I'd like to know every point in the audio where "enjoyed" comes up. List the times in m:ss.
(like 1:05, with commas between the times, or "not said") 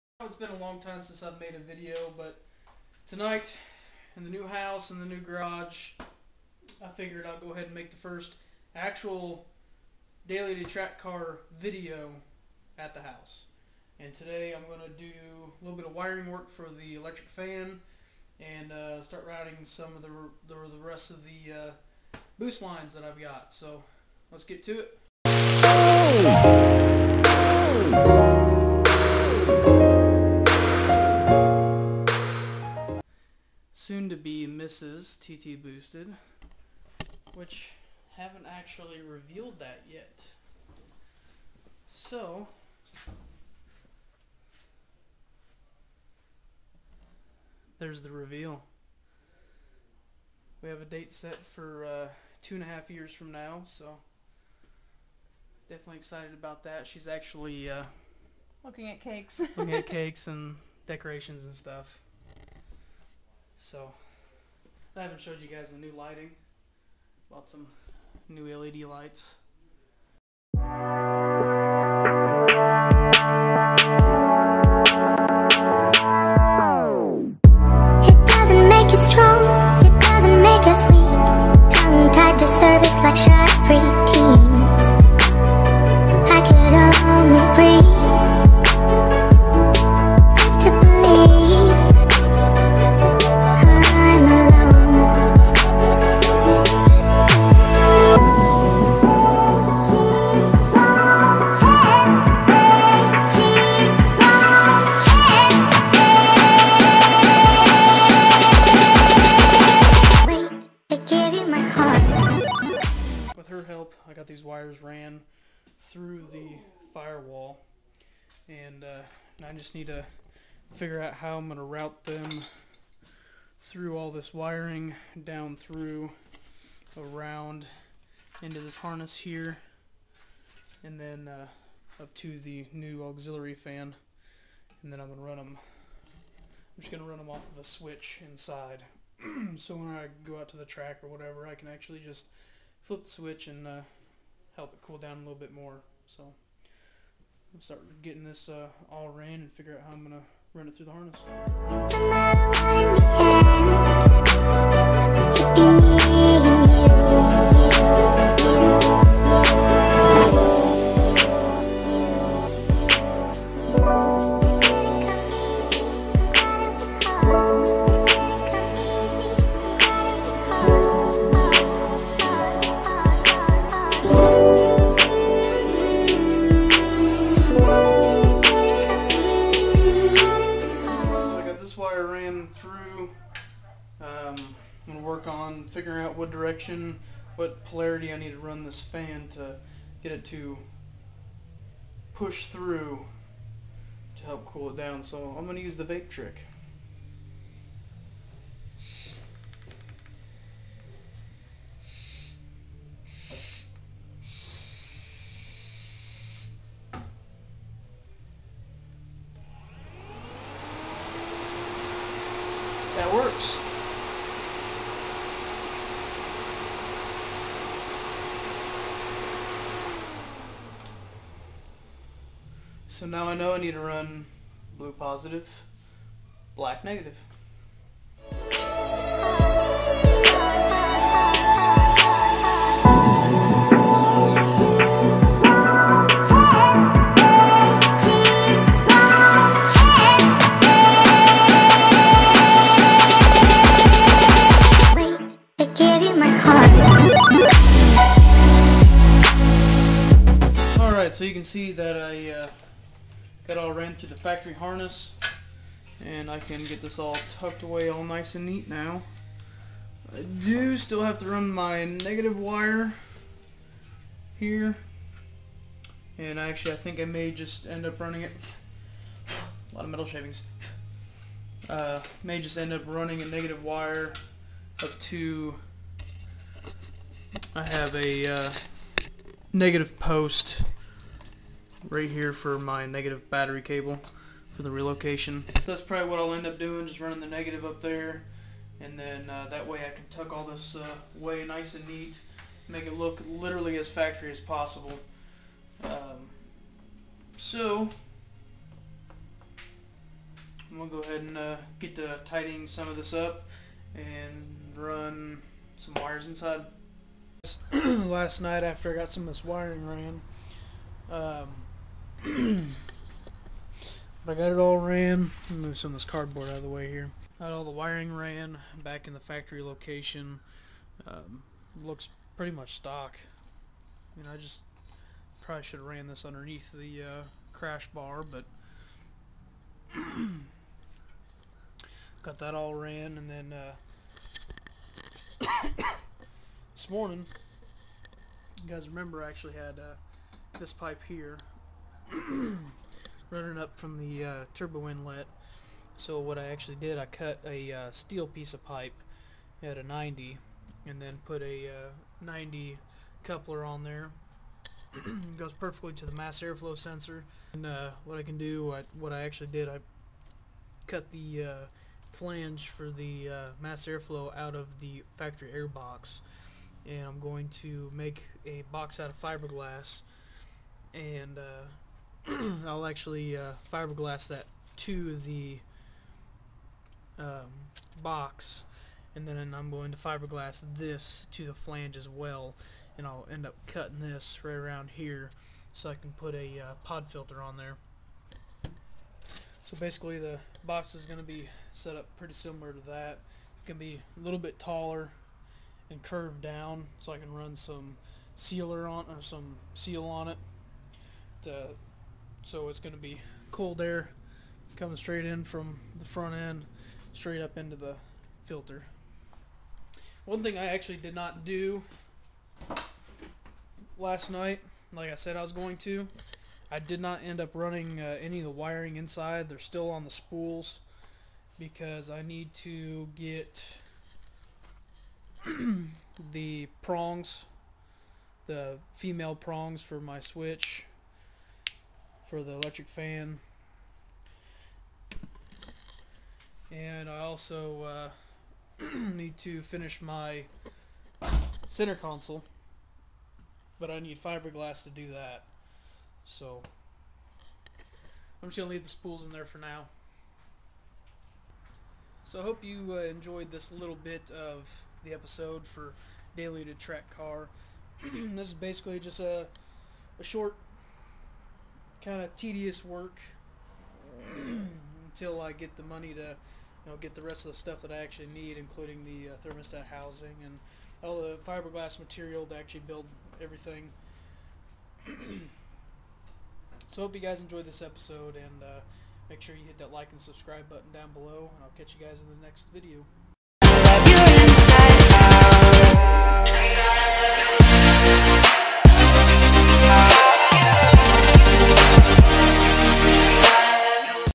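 7:33, 7:57.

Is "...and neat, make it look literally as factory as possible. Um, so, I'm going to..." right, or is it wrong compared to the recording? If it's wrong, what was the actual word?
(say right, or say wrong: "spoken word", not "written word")
right.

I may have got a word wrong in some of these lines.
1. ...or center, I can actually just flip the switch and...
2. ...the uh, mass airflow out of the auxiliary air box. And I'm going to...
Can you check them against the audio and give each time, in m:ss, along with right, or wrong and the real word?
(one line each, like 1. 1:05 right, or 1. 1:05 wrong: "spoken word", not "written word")
1. 2:21 wrong: "whatever", not "center"
2. 6:02 wrong: "factory", not "auxiliary".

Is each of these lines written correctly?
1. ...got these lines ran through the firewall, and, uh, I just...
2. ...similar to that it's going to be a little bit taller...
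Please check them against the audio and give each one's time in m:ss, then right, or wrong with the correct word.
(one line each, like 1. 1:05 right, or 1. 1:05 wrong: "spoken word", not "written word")
1. 1:54 wrong: "wires", not "lines"
2. 6:32 right.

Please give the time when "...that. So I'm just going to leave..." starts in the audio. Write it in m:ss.
7:25.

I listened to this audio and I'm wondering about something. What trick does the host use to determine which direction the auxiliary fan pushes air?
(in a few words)
The vape trick.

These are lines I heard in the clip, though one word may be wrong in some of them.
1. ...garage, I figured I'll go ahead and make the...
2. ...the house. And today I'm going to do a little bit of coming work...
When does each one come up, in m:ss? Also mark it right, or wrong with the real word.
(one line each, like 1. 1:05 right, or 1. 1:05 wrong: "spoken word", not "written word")
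1. 0:05 right
2. 0:12 wrong: "wiring", not "coming".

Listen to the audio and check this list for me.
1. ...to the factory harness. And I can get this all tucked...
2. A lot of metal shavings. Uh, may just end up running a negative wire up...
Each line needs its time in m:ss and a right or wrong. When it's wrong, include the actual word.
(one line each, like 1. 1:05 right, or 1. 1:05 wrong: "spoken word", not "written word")
1. 4:13 right
2. 4:29 right.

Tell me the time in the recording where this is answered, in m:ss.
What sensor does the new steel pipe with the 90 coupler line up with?
5:56.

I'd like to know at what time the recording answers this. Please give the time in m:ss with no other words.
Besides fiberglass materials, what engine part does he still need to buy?
7:49.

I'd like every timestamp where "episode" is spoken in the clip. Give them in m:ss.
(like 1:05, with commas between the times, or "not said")
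7:35, 7:57.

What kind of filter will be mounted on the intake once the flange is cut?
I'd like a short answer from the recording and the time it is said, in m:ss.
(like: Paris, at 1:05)
Pod filter, at 6:26.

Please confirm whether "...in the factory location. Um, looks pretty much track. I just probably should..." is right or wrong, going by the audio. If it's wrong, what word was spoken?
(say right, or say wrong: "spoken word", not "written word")
wrong: "stock", not "track".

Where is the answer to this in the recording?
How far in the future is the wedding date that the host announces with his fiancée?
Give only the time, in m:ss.
0:52.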